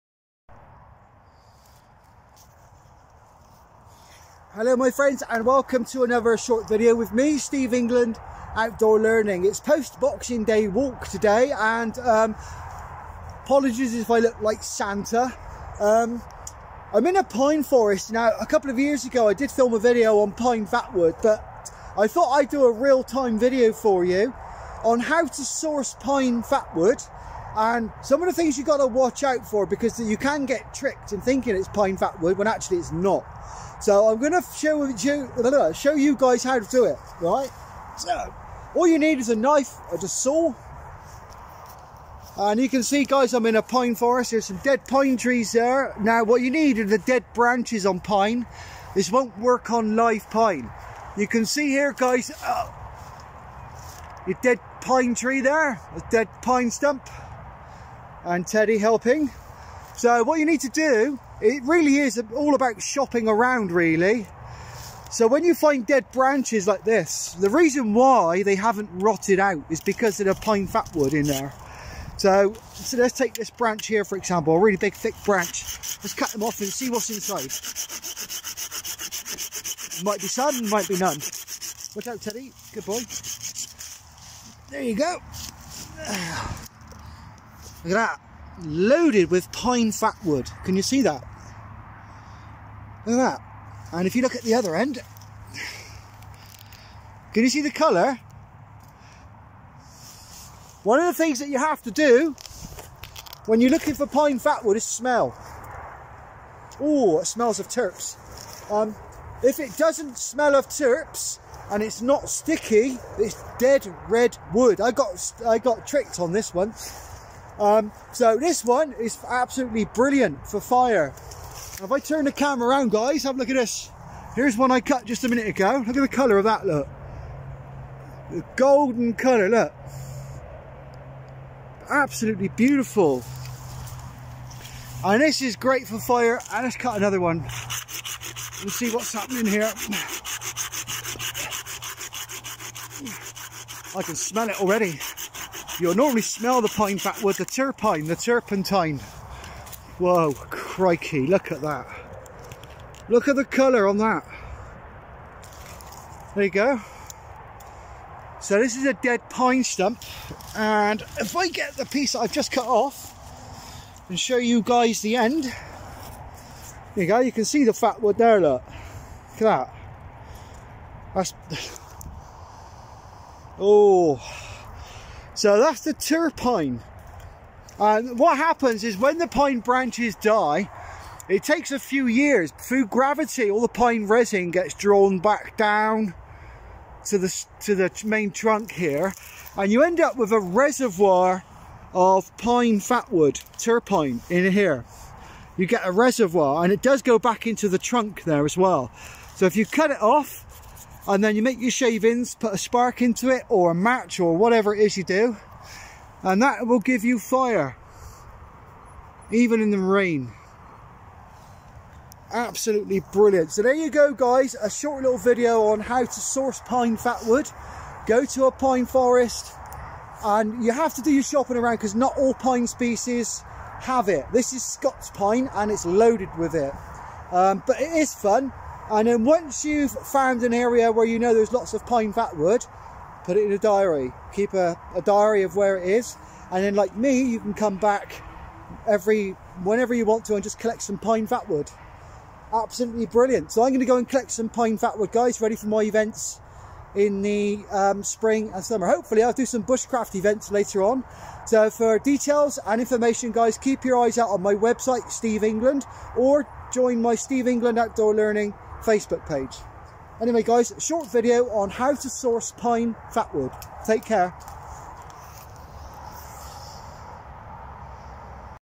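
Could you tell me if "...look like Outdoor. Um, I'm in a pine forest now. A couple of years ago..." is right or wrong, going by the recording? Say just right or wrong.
wrong.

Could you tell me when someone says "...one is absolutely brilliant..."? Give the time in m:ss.
1:58.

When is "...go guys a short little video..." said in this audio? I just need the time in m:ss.
3:33.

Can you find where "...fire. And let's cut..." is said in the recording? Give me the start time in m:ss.
2:15.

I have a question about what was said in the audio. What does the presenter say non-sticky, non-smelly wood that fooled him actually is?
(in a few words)
dead red wood.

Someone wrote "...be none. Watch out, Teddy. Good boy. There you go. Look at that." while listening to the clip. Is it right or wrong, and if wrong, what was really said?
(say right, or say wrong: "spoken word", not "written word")
right.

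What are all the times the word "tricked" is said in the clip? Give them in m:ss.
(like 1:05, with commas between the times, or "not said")
0:30, 1:55.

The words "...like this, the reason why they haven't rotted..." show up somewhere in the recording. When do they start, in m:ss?
1:06.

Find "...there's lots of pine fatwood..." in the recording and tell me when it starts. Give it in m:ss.
3:51.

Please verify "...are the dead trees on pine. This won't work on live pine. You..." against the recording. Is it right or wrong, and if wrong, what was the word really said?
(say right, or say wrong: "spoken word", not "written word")
wrong: "branches", not "trees".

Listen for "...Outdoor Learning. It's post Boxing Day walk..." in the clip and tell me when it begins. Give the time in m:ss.
0:08.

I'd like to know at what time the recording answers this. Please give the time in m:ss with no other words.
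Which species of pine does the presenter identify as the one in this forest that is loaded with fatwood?
3:44.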